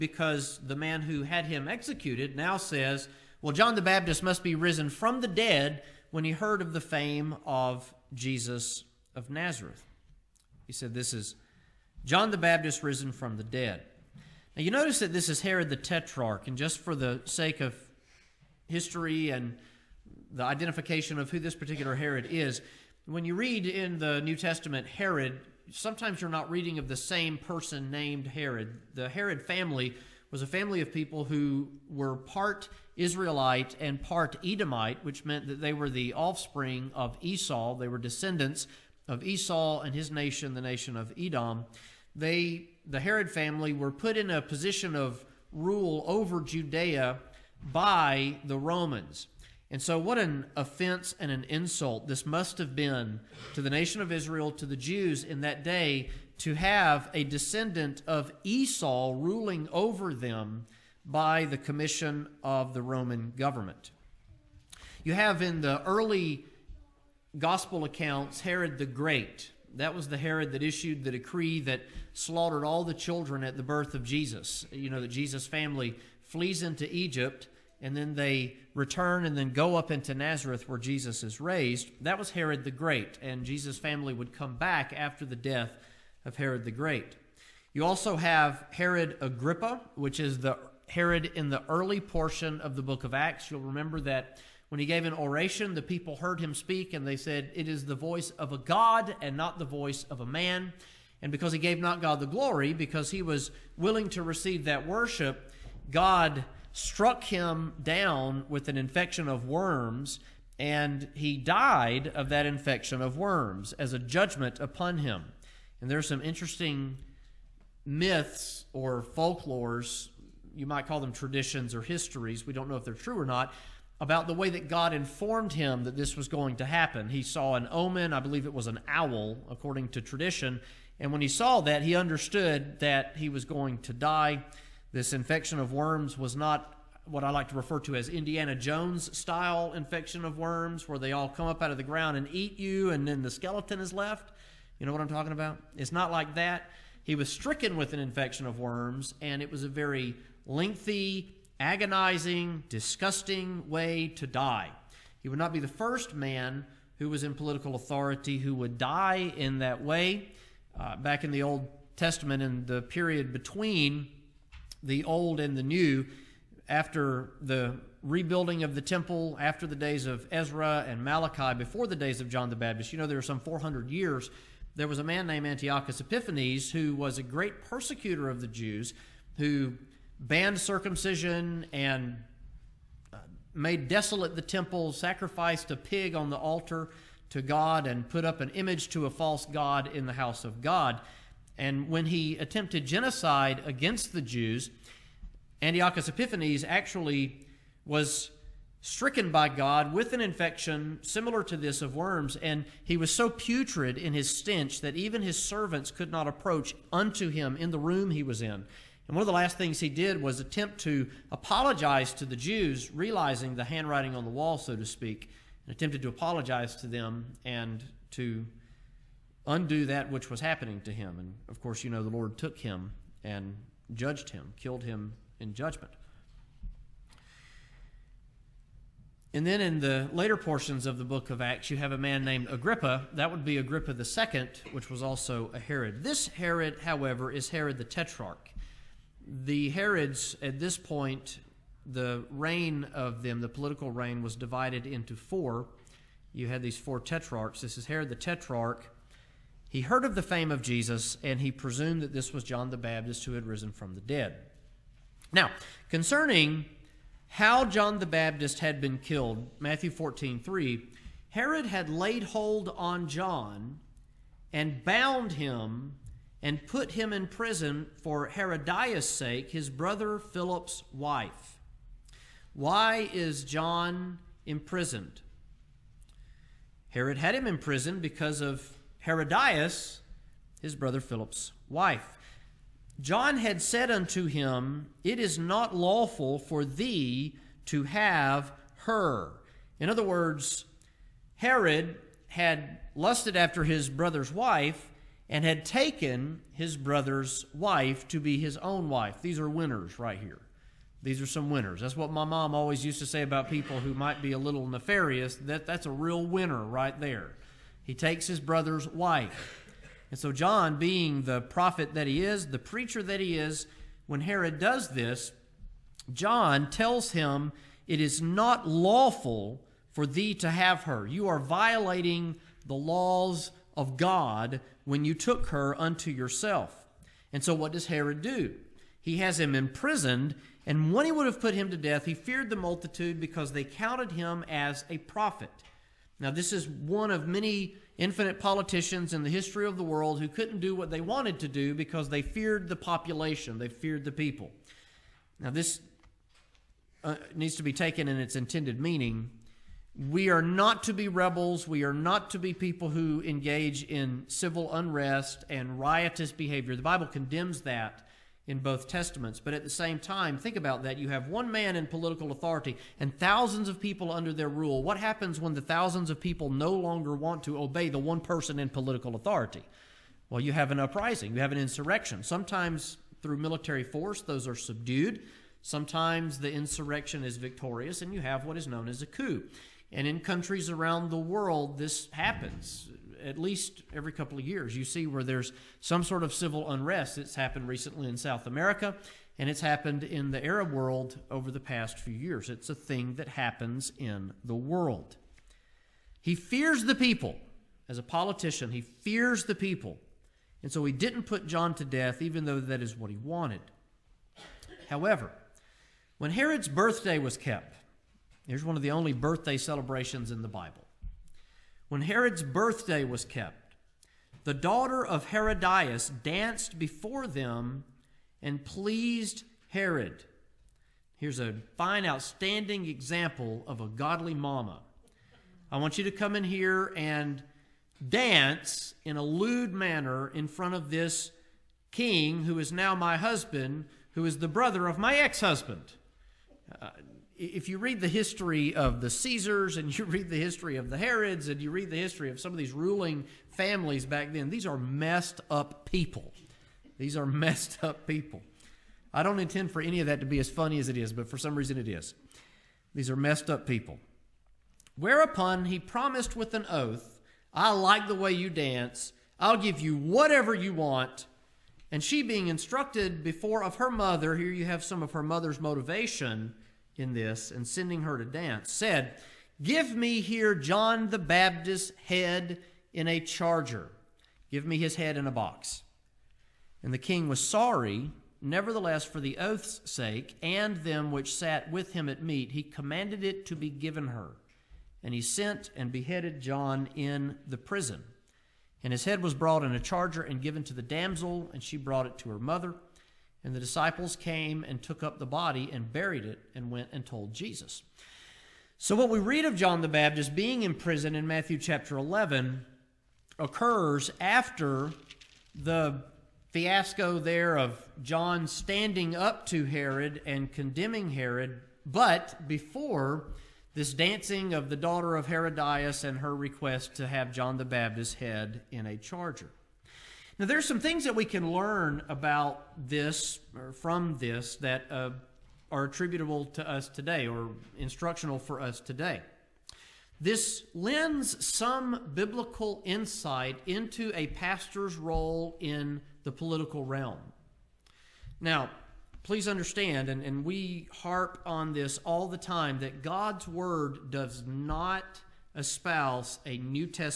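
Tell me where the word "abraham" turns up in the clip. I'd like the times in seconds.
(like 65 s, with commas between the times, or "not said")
not said.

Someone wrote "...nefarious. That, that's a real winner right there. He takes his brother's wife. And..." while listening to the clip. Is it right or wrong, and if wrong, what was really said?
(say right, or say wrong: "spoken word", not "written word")
right.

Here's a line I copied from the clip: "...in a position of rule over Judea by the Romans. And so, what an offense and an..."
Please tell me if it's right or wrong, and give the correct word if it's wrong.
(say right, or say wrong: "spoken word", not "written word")
right.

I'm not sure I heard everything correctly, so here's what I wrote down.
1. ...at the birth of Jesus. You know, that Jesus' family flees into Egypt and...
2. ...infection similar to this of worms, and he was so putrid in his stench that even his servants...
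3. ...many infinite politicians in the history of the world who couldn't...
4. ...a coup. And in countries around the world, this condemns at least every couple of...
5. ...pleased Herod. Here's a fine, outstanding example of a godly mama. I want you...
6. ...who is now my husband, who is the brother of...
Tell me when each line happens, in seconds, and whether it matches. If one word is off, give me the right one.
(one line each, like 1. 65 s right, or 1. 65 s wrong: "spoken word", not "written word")
1. 73 s right
2. 200 s right
3. 337 s right
4. 379 s wrong: "happens", not "condemns"
5. 418 s right
6. 432 s right.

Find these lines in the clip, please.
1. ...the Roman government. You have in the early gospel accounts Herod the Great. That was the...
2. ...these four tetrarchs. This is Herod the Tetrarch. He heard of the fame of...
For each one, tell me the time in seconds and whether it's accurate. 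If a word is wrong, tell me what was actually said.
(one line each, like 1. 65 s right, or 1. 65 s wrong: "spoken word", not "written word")
1. 62 s right
2. 246 s right.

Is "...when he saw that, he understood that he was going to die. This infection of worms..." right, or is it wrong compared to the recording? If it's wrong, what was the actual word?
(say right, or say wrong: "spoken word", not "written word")
right.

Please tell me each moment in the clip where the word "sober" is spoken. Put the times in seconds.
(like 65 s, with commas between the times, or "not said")
not said.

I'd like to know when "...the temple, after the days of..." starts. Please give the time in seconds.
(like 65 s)
168 s.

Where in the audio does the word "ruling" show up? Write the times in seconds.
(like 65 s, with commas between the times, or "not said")
59 s, 442 s.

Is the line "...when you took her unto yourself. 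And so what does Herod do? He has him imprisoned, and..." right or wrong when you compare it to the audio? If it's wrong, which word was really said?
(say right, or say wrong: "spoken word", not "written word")
right.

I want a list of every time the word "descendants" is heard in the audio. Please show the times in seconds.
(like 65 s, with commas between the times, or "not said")
37 s, 57 s.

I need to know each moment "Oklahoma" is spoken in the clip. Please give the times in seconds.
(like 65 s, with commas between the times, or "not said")
not said.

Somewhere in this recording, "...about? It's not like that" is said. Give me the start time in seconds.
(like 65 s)
145 s.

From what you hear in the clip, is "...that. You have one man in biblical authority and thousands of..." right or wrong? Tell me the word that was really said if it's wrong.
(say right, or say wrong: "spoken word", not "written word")
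wrong: "political", not "biblical".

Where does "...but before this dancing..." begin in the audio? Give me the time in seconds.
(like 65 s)
511 s.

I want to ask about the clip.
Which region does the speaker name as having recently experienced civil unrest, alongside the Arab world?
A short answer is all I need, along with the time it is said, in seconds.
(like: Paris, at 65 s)
South America, at 388 s.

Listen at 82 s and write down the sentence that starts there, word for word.
That was Herod the Great, and Jesus' family would come back after the death of Herod the Great.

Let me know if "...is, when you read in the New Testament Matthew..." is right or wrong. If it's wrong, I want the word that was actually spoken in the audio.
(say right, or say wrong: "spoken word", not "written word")
wrong: "Herod", not "Matthew".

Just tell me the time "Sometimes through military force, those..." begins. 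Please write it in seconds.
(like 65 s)
372 s.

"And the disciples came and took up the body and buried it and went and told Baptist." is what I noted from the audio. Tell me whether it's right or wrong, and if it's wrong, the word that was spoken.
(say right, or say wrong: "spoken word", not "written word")
wrong: "Jesus", not "Baptist".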